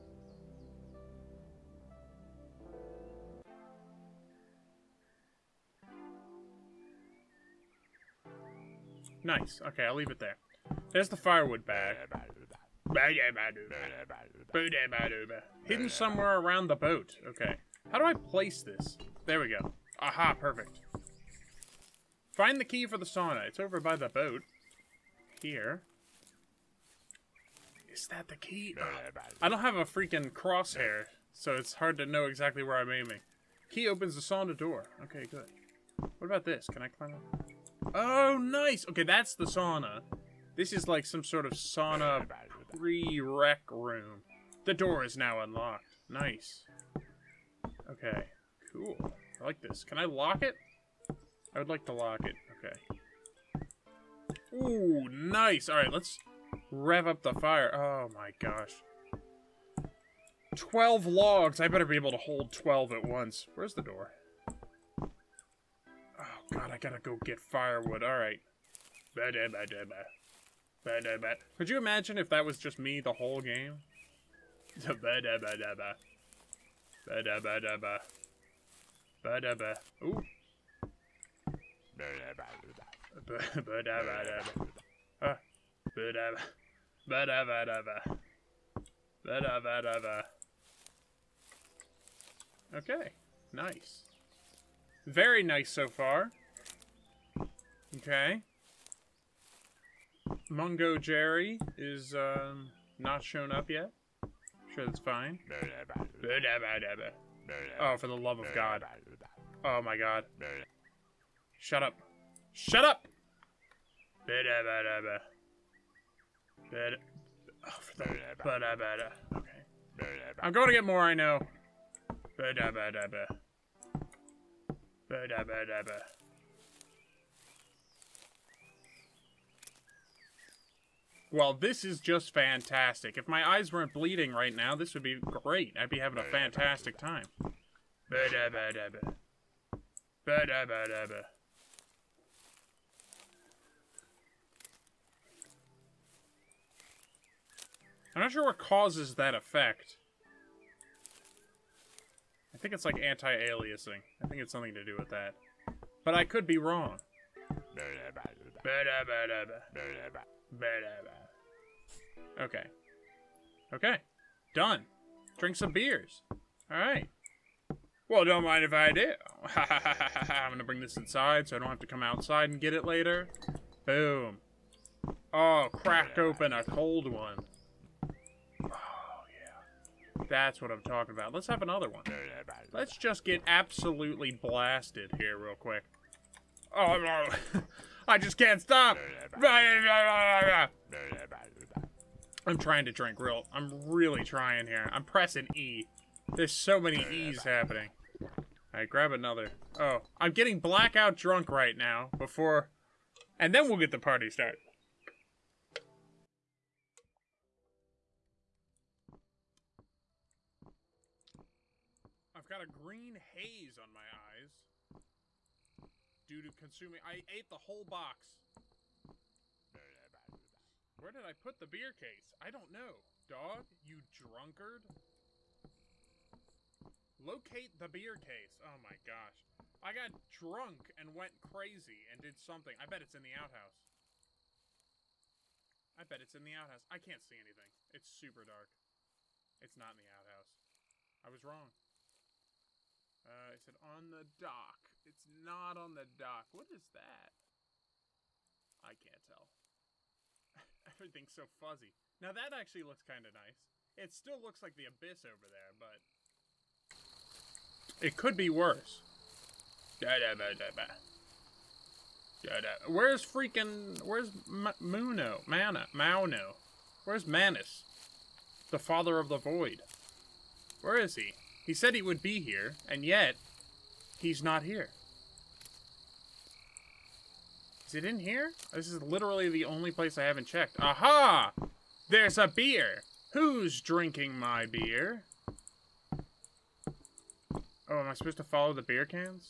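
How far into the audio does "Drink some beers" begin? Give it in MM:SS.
02:45.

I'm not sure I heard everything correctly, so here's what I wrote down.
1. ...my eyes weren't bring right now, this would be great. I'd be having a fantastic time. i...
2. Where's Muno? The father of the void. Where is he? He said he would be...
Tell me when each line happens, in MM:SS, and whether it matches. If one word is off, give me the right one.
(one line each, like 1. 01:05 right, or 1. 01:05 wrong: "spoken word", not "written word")
1. 02:13 wrong: "bleeding", not "bring"
2. 04:27 wrong: "Manus", not "Muno".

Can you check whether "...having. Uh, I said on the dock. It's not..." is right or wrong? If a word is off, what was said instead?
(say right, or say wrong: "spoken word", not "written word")
wrong: "wrong", not "having".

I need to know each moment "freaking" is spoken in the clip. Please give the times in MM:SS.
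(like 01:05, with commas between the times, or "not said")
00:29, 04:23.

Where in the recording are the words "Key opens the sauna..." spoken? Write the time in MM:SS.
00:33.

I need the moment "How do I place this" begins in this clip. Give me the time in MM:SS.
00:17.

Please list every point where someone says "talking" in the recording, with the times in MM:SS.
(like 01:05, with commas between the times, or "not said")
03:00.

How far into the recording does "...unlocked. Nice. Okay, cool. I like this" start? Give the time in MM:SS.
00:45.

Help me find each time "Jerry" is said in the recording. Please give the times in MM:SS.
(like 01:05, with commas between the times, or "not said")
01:40.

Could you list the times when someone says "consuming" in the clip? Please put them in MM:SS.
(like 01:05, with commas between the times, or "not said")
03:36.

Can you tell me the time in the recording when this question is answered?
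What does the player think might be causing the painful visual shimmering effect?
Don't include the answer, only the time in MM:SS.
02:33.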